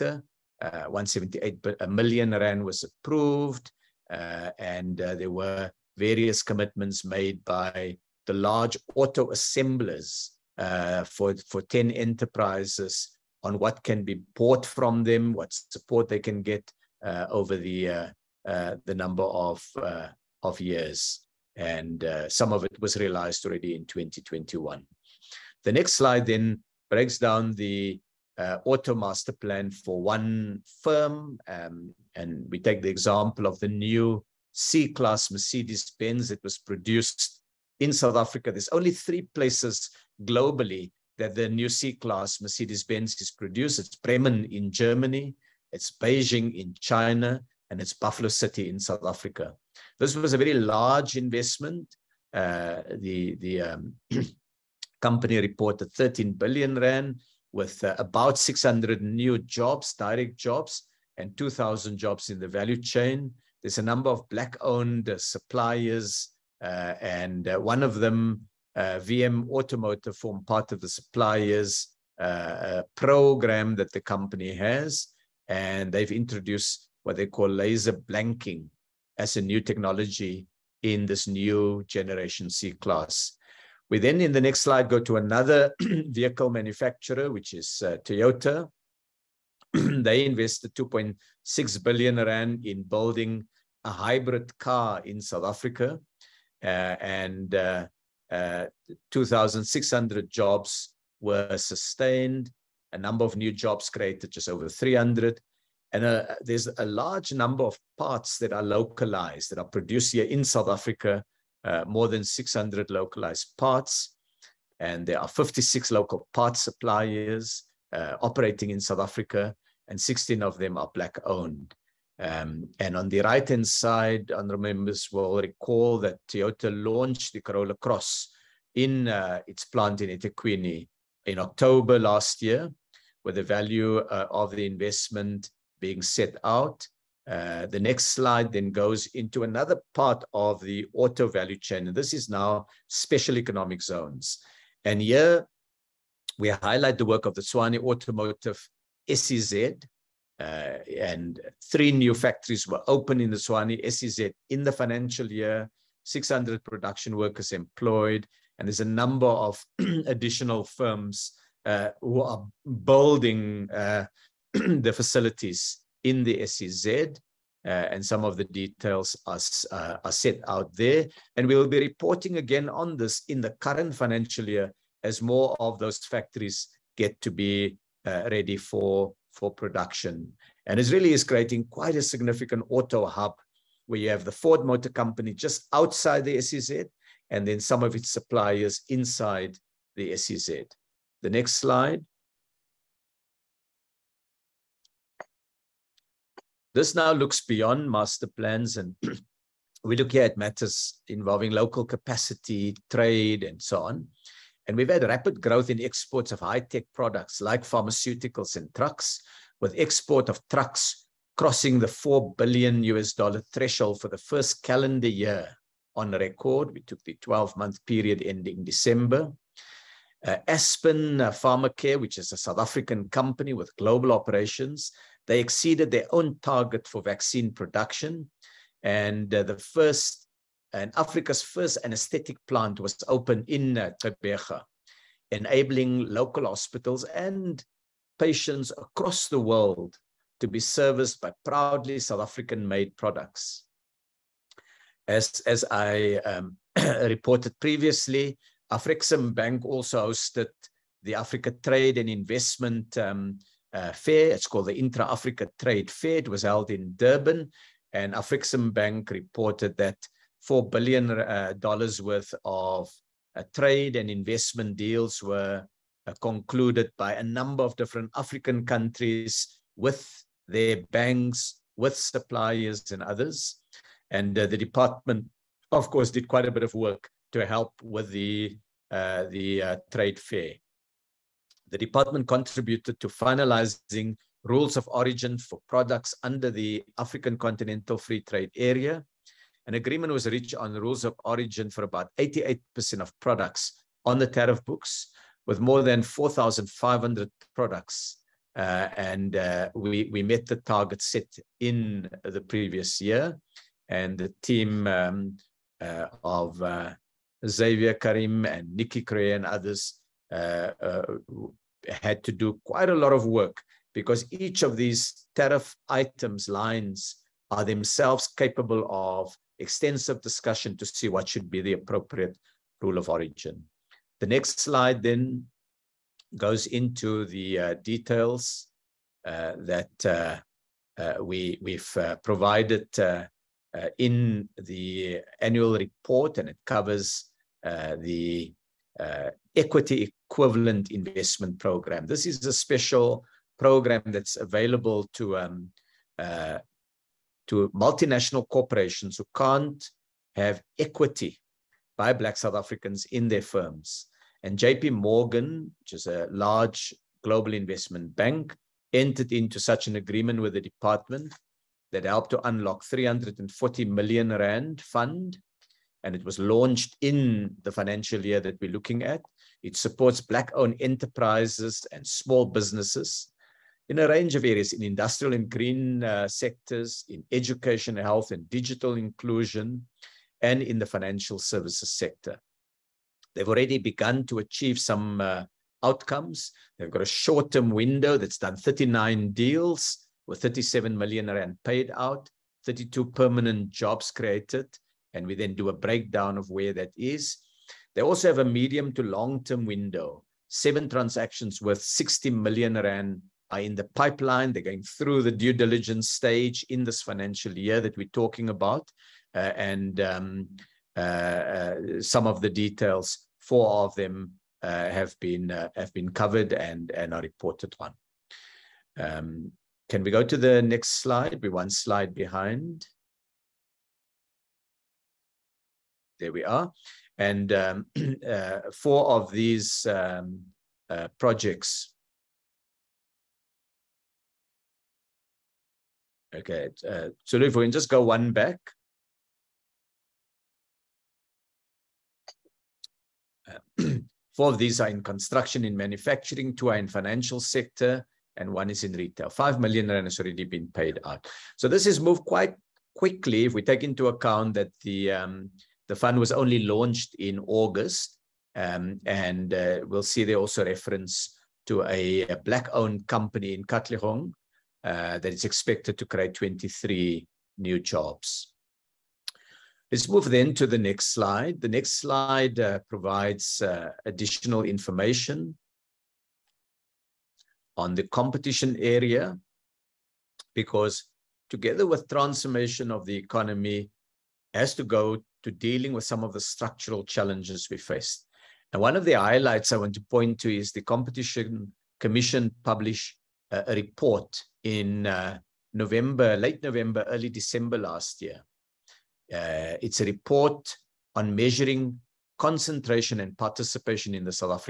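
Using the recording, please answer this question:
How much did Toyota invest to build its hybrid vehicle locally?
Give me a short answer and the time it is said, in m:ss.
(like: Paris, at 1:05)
2.6 billion rand, at 1:30.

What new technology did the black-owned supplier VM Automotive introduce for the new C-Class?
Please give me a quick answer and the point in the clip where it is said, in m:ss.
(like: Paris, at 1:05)
laser blanking, at 1:17.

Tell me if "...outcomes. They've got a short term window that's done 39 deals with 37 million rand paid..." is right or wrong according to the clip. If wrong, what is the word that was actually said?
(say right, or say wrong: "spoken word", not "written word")
right.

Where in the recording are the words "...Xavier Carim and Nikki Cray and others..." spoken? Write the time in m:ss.
5:07.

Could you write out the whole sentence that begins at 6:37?
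They also have a medium to long-term window.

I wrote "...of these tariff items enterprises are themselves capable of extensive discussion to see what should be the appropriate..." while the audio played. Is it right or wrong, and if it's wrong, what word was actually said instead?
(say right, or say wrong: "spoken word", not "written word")
wrong: "lines", not "enterprises".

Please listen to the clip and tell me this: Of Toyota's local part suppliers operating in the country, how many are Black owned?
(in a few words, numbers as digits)
16.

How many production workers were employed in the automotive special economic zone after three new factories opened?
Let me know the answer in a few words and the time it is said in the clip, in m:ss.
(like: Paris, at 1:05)
600, at 2:36.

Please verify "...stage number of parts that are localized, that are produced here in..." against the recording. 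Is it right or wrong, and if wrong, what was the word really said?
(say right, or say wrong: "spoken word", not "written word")
wrong: "large", not "stage".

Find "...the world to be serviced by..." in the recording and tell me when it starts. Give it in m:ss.
3:59.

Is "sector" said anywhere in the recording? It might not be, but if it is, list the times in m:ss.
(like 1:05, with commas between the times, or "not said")
6:16, 6:21, 7:27.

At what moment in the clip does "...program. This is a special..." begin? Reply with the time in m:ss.
5:41.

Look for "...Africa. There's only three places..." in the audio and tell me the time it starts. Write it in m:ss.
0:38.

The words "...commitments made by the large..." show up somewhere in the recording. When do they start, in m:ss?
0:06.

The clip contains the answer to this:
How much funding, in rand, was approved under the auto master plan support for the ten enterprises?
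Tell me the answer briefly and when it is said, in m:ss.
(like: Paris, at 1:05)
178 million rand, at 0:00.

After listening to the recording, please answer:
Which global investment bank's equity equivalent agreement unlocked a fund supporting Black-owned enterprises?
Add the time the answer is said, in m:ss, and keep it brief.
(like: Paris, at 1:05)
JP Morgan, at 5:54.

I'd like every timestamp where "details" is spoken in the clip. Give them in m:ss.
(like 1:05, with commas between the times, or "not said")
2:48, 5:27, 6:52.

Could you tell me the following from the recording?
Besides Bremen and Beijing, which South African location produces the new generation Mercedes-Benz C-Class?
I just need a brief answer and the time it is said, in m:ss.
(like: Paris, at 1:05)
Buffalo City, at 0:47.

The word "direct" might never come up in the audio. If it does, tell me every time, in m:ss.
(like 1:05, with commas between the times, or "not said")
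0:59.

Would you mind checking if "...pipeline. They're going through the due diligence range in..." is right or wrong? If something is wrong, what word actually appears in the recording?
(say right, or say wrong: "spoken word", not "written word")
wrong: "stage", not "range".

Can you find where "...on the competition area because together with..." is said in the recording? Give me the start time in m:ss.
7:57.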